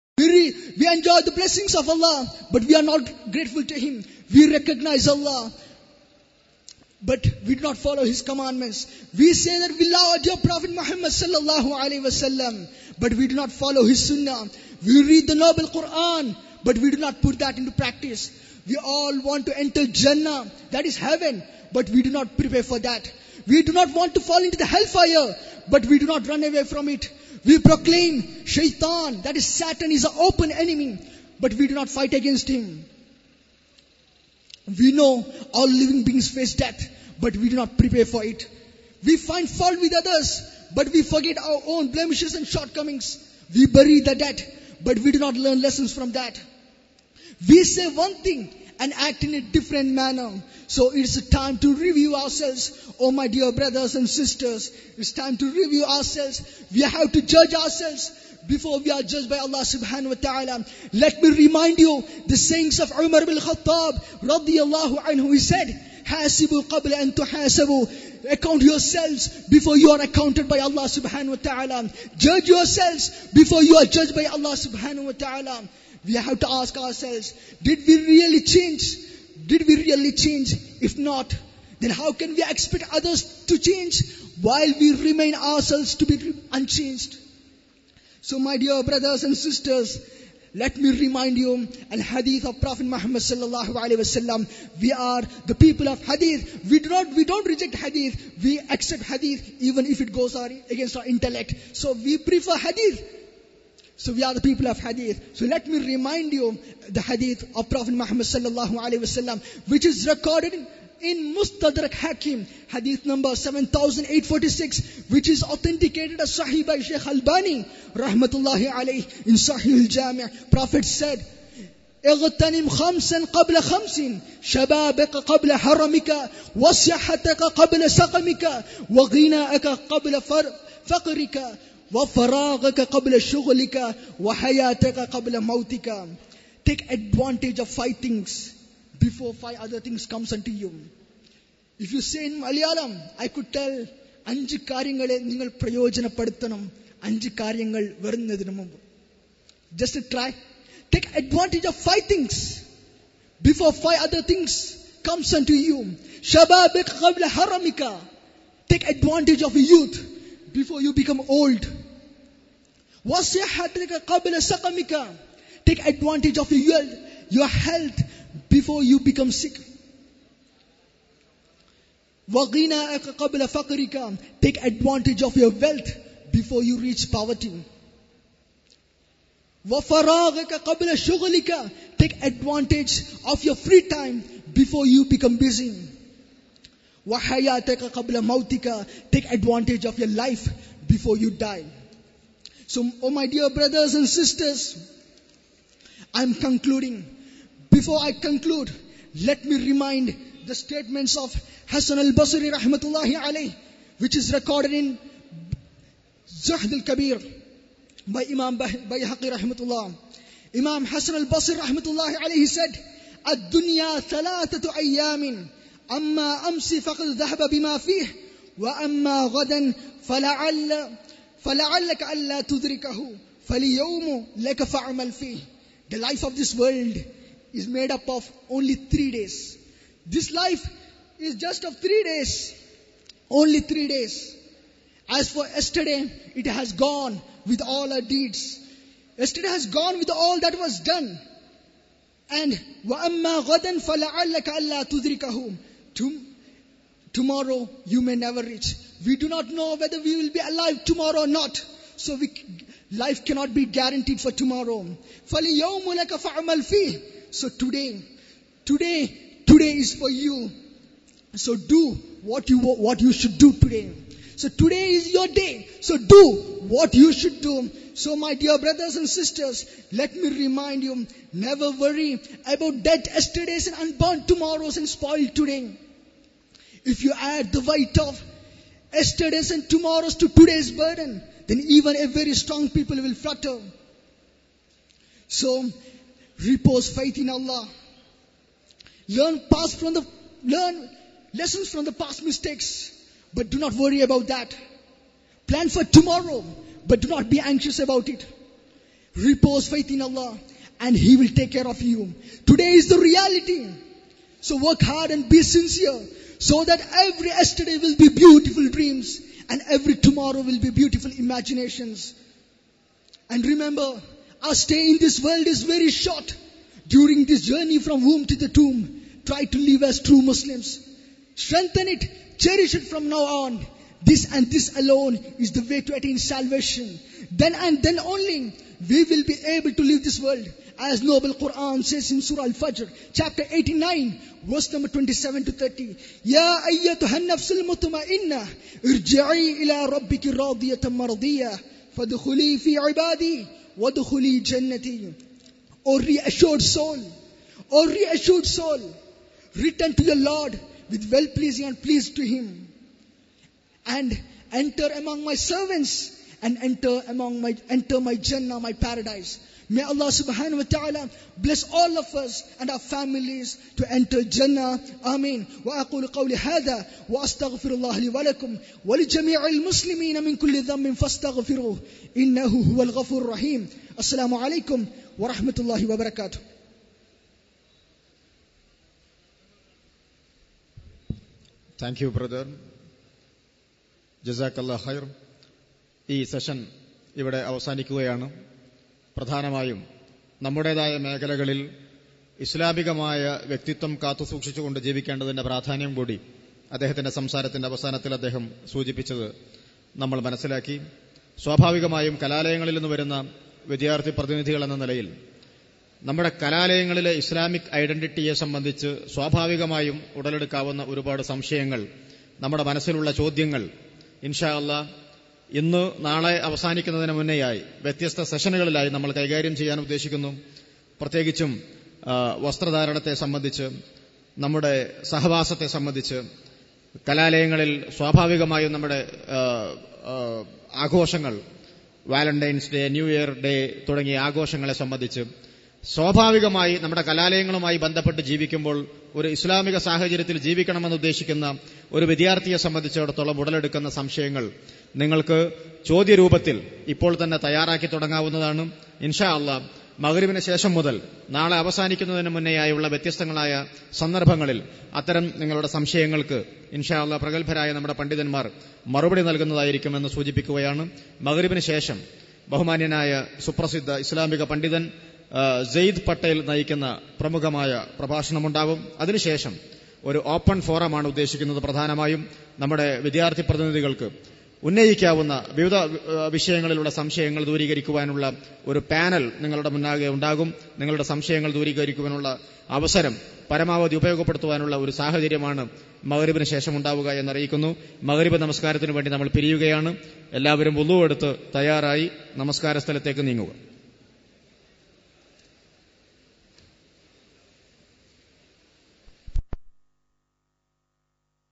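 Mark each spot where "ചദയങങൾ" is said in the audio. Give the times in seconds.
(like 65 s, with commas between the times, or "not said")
413 s.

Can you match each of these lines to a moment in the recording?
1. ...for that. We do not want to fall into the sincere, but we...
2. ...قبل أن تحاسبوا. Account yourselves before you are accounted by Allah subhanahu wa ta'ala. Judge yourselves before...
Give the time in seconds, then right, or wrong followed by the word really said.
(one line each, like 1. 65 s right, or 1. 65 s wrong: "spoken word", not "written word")
1. 22 s wrong: "hellfire", not "sincere"
2. 66 s right.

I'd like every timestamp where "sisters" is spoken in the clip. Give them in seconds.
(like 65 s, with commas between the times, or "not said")
54 s, 89 s, 194 s, 269 s.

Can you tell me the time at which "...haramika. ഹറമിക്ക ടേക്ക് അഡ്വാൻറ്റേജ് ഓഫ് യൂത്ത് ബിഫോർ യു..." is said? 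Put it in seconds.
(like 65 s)
156 s.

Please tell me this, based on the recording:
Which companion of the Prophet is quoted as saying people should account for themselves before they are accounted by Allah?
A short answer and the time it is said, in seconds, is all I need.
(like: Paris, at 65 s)
Umar bin Khattab, at 62 s.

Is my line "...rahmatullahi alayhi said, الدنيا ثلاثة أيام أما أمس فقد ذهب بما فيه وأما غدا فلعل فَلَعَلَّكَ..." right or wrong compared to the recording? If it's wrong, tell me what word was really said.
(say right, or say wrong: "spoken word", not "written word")
right.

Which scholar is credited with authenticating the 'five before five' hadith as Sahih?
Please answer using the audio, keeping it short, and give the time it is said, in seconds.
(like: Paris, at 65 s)
Sheikh Albani, at 116 s.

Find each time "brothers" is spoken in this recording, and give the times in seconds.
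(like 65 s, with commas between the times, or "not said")
53 s, 88 s, 193 s, 268 s, 382 s.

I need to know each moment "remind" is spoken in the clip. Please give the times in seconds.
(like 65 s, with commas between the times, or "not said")
61 s, 90 s, 105 s, 199 s, 270 s.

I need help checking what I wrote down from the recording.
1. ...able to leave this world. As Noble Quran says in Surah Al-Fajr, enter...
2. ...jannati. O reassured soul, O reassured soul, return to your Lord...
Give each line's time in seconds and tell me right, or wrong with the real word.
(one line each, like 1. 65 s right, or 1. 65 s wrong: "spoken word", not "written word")
1. 329 s wrong: "chapter", not "enter"
2. 344 s right.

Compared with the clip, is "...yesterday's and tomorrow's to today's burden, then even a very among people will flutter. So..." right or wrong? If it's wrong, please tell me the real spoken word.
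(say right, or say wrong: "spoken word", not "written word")
wrong: "strong", not "among".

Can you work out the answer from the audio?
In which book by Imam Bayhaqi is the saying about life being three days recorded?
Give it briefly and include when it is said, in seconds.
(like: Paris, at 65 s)
Zuhd al-Kabir, at 206 s.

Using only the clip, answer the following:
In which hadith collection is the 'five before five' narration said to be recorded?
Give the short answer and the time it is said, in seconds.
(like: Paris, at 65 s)
Mustadrak Hakim, at 111 s.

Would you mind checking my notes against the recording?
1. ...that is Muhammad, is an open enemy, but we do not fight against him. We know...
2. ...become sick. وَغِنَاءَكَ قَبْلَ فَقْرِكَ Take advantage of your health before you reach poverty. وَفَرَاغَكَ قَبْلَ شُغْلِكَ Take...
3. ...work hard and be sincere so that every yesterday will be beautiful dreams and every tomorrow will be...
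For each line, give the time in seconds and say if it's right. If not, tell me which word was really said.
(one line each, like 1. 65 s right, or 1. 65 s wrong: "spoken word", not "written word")
1. 29 s wrong: "Satan", not "Muhammad"
2. 168 s wrong: "wealth", not "health"
3. 304 s right.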